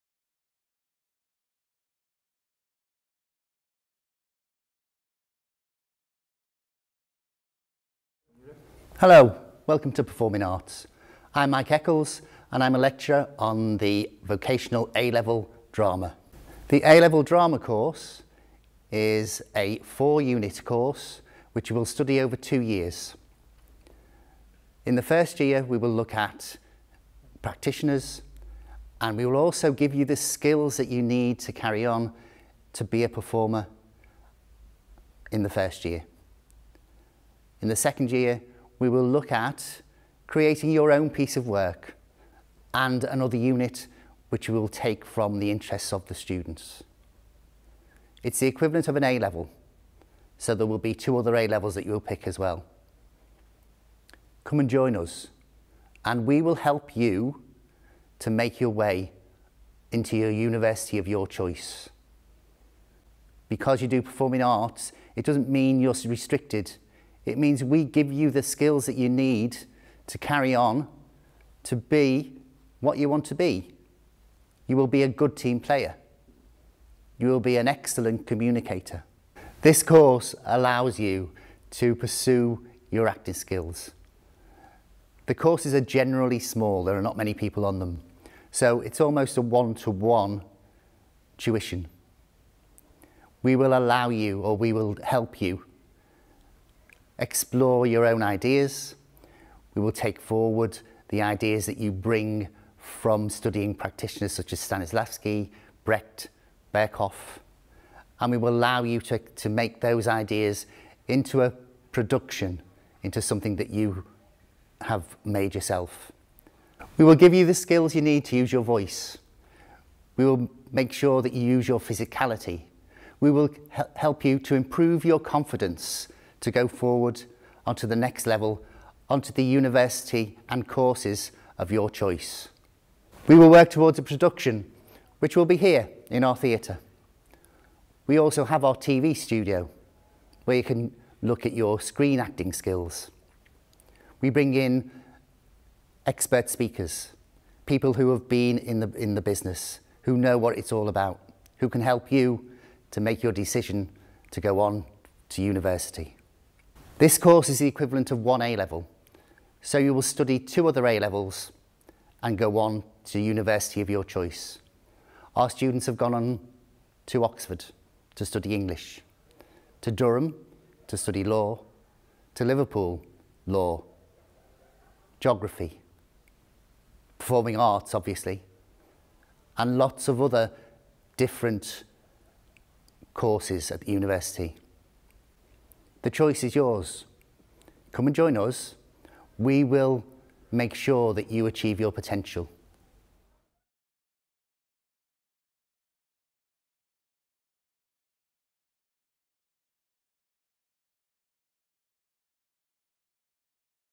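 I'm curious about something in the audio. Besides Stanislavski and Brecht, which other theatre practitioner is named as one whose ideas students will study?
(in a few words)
Berkoff.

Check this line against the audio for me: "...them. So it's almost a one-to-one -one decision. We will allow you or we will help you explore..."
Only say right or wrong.
wrong.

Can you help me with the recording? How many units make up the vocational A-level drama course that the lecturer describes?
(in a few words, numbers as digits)
4.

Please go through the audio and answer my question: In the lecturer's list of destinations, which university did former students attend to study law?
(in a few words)
Durham.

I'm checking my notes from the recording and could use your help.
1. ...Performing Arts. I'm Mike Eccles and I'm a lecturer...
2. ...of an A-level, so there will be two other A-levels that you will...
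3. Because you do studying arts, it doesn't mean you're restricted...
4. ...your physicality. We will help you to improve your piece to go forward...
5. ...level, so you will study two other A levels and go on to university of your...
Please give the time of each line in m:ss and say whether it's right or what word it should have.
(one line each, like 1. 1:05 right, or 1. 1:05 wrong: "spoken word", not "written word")
1. 0:10 right
2. 0:48 right
3. 1:03 wrong: "performing", not "studying"
4. 2:01 wrong: "confidence", not "piece"
5. 2:38 right.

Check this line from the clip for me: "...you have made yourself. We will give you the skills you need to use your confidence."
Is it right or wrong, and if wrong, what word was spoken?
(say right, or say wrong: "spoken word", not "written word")
wrong: "voice", not "confidence".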